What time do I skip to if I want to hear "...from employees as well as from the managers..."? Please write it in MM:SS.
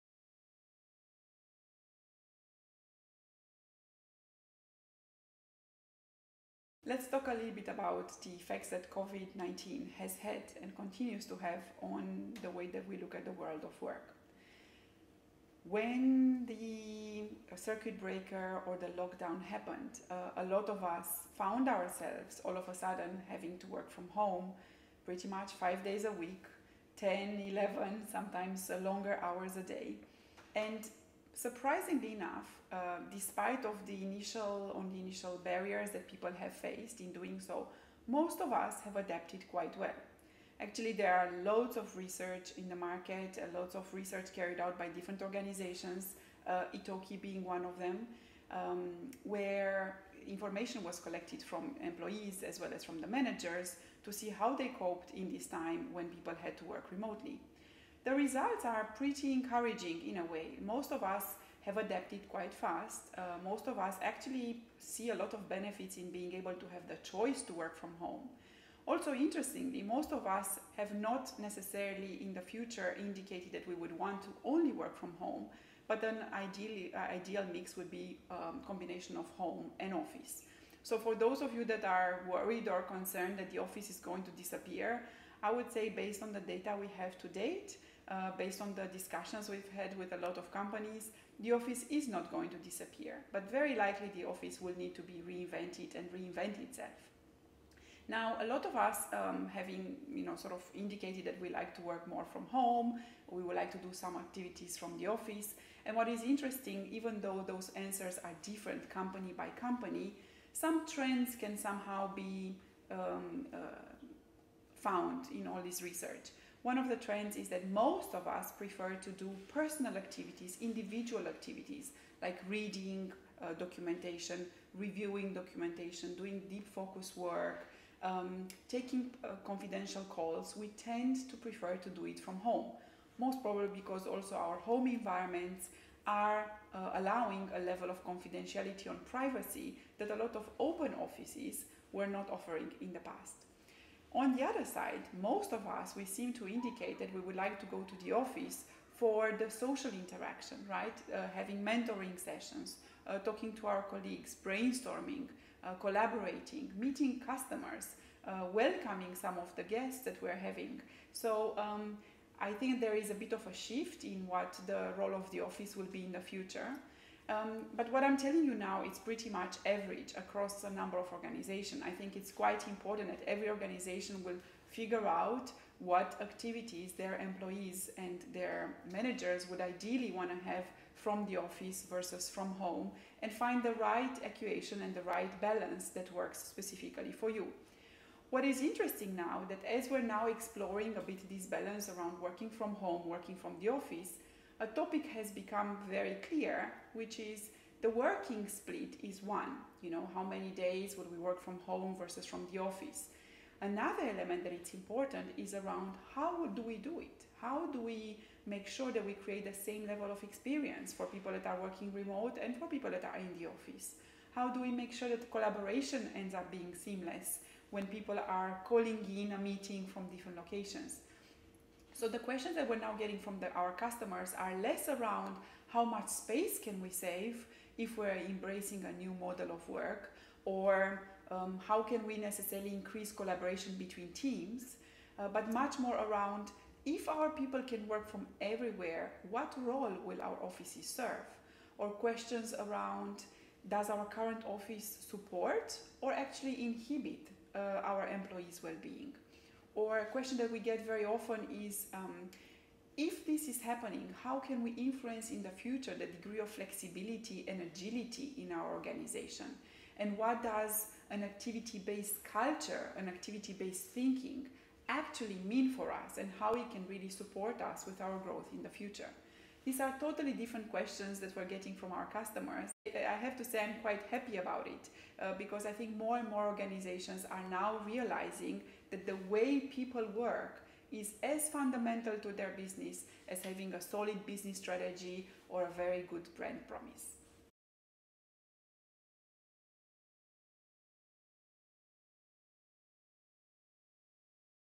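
00:51.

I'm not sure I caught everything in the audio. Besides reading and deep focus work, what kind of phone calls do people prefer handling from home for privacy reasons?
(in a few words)
Confidential calls.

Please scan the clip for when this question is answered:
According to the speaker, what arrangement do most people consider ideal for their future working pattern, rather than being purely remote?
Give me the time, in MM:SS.
01:18.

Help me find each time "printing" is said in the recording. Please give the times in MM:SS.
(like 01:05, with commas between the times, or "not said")
not said.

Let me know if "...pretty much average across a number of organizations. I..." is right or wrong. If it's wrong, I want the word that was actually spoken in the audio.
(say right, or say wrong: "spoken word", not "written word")
right.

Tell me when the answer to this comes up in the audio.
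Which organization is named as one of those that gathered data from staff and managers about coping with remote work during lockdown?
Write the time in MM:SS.
00:46.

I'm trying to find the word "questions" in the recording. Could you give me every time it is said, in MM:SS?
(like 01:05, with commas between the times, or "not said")
03:42, 04:01, 04:10, 04:30.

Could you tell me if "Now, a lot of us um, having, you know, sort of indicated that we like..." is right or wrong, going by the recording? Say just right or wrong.
right.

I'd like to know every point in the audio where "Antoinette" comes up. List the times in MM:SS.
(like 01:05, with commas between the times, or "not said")
not said.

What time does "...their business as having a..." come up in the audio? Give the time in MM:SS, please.
04:42.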